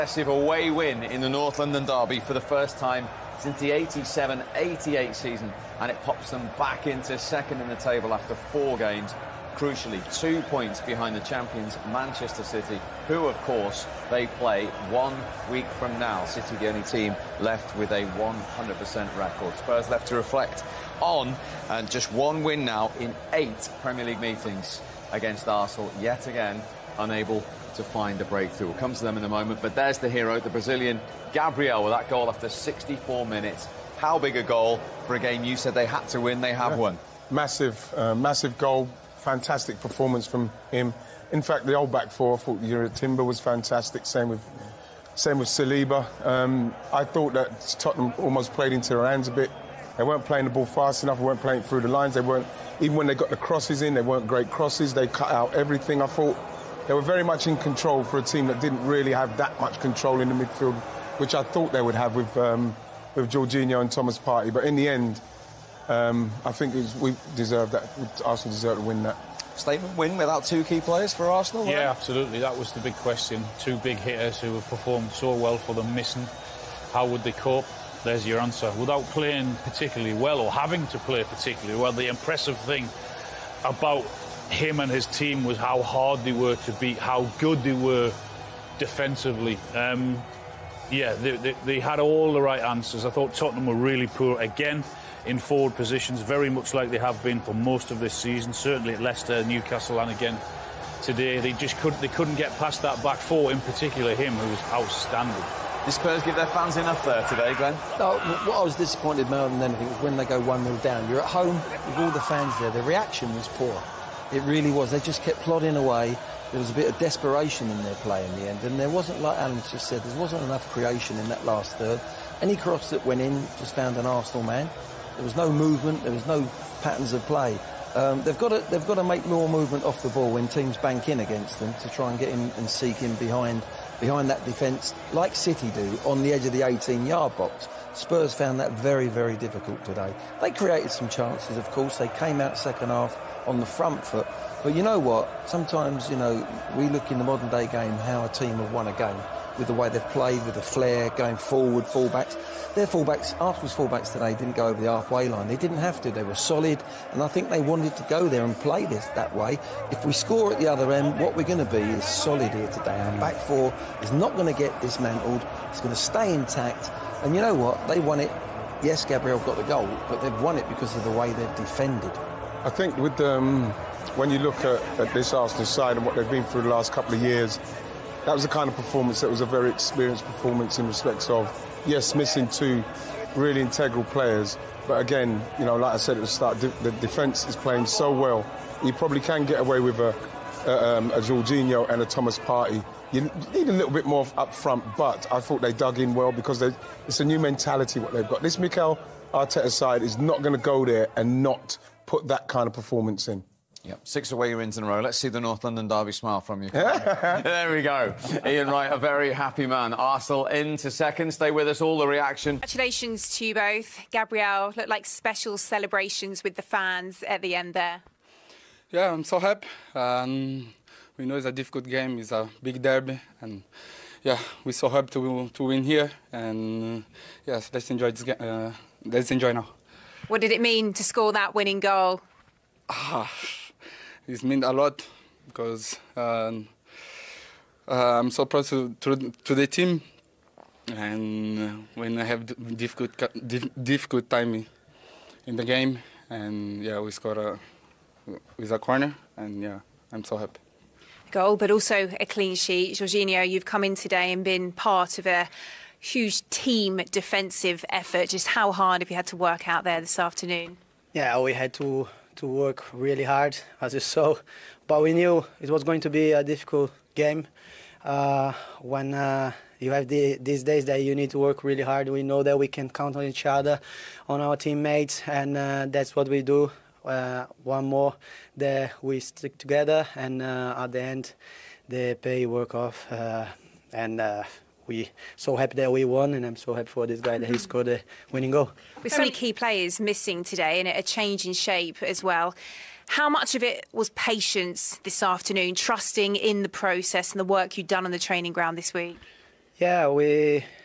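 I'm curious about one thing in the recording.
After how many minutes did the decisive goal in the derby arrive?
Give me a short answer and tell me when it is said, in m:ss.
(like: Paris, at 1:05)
64, at 0:32.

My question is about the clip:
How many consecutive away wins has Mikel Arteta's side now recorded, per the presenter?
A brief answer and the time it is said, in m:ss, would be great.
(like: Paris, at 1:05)
6, at 3:24.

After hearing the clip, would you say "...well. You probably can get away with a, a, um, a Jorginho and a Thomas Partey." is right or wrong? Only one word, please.
right.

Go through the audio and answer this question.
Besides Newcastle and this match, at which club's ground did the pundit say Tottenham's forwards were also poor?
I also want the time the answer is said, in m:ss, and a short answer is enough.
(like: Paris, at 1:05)
Leicester, at 1:39.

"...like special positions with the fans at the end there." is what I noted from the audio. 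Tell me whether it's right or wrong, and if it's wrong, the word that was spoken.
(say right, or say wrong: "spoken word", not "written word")
wrong: "celebrations", not "positions".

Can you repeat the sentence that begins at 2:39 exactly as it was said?
If we score at the other end, what we're going to be is solid here today.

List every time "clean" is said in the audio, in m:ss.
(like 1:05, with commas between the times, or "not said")
4:12.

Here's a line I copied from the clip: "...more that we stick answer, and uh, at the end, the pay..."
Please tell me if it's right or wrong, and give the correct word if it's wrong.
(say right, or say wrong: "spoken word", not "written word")
wrong: "together", not "answer".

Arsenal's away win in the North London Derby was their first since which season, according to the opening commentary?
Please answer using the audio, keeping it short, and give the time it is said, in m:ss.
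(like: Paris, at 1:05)
1987-88, at 0:03.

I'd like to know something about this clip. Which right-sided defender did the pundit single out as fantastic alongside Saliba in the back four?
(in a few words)
Jurrien Timber.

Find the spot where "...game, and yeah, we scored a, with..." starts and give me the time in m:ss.
4:05.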